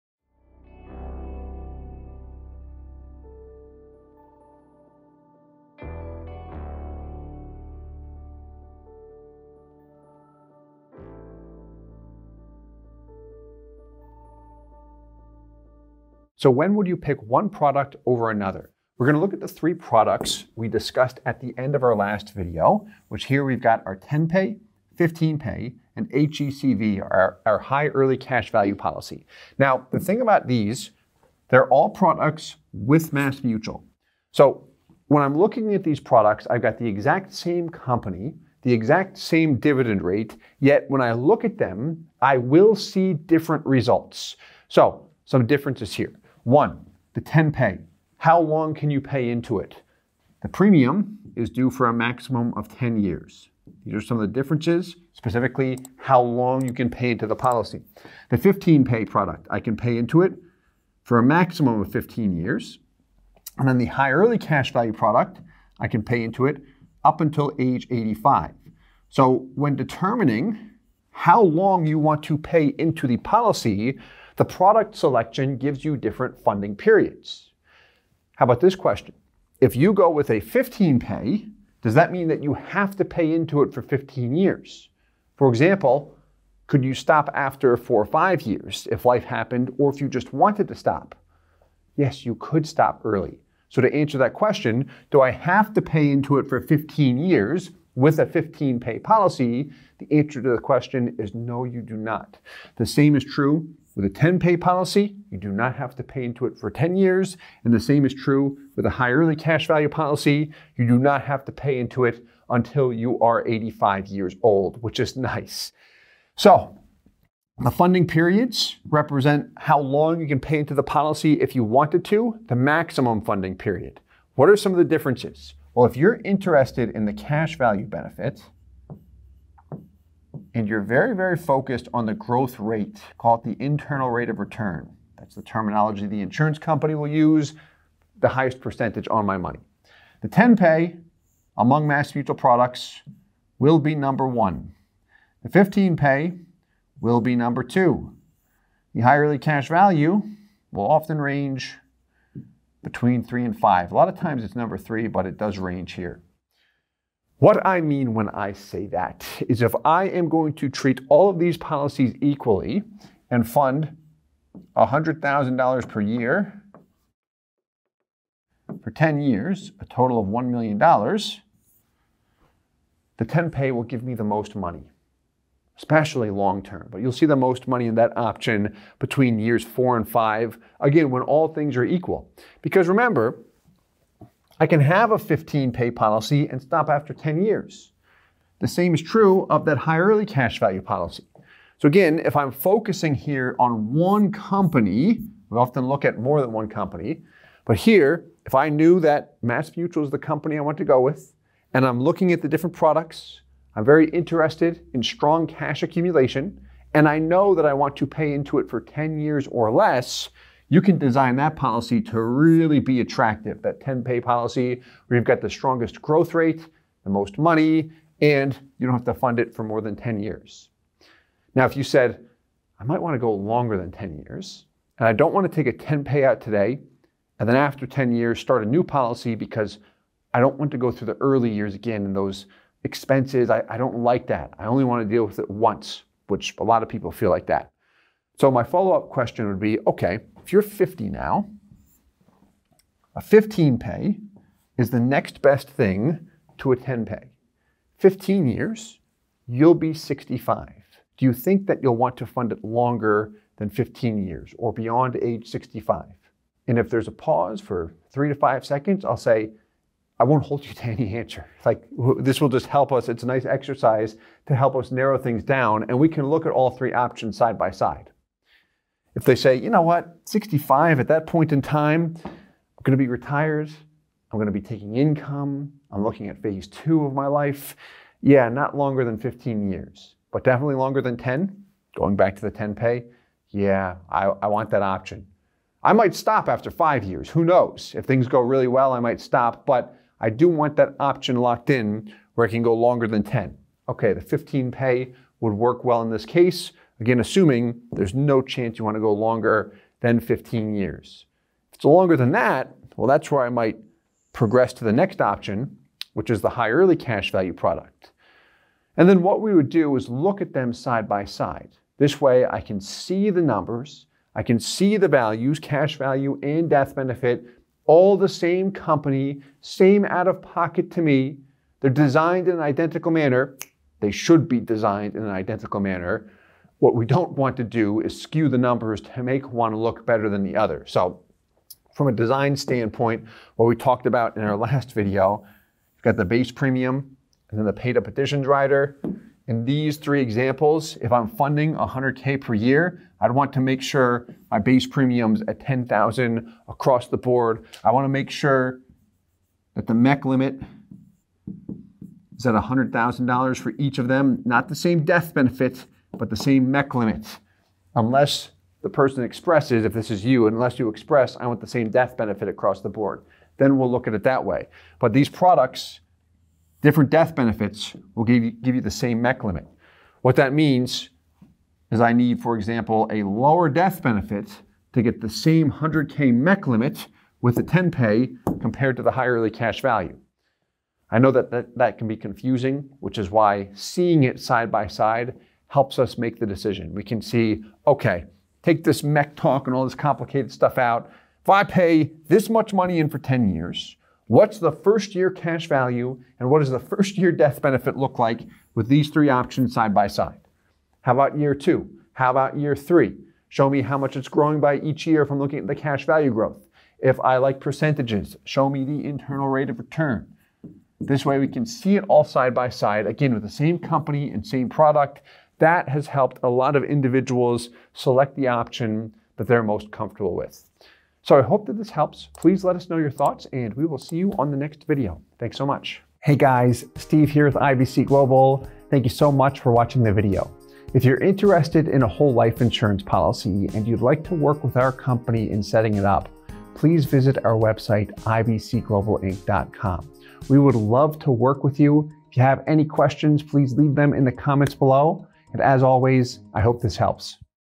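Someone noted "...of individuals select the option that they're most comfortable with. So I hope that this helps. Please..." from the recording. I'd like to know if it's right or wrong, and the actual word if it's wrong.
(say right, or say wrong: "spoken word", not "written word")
right.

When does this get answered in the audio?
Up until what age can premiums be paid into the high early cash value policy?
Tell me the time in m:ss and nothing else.
1:07.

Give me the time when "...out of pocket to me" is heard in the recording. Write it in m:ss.
5:20.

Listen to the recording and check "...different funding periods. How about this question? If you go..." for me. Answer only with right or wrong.
right.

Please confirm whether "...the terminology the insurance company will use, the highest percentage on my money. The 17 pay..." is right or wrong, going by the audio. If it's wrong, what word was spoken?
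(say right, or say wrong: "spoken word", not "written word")
wrong: "10", not "17".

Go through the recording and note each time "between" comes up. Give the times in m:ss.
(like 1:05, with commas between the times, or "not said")
2:32, 2:58.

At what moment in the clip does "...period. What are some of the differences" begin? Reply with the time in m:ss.
2:03.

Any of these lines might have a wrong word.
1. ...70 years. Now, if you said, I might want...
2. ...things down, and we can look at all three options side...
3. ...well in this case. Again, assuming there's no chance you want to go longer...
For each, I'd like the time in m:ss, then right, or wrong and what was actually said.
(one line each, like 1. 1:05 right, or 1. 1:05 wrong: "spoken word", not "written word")
1. 3:39 wrong: "10", not "70"
2. 4:25 right
3. 4:55 right.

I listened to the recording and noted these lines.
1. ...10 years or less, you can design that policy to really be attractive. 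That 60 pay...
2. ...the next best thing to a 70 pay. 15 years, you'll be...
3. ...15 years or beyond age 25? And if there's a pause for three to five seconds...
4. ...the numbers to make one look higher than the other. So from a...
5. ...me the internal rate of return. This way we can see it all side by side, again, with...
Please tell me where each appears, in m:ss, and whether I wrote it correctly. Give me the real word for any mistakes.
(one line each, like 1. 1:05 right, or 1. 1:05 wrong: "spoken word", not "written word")
1. 3:28 wrong: "10", not "60"
2. 4:04 wrong: "10", not "70"
3. 4:13 wrong: "65", not "25"
4. 5:28 wrong: "better", not "higher"
5. 6:48 right.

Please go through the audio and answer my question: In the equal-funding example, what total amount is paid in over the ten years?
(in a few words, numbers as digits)
$1 million.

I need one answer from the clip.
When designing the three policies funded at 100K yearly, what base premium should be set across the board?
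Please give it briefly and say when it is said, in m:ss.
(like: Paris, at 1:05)
$10,000, at 5:45.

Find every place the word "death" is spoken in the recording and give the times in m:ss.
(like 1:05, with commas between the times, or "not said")
5:16, 5:55, 6:01, 6:07, 6:13, 6:37.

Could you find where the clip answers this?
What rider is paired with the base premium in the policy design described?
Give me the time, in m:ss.
5:37.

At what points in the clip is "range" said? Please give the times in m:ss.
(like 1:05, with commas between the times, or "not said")
2:31, 2:35.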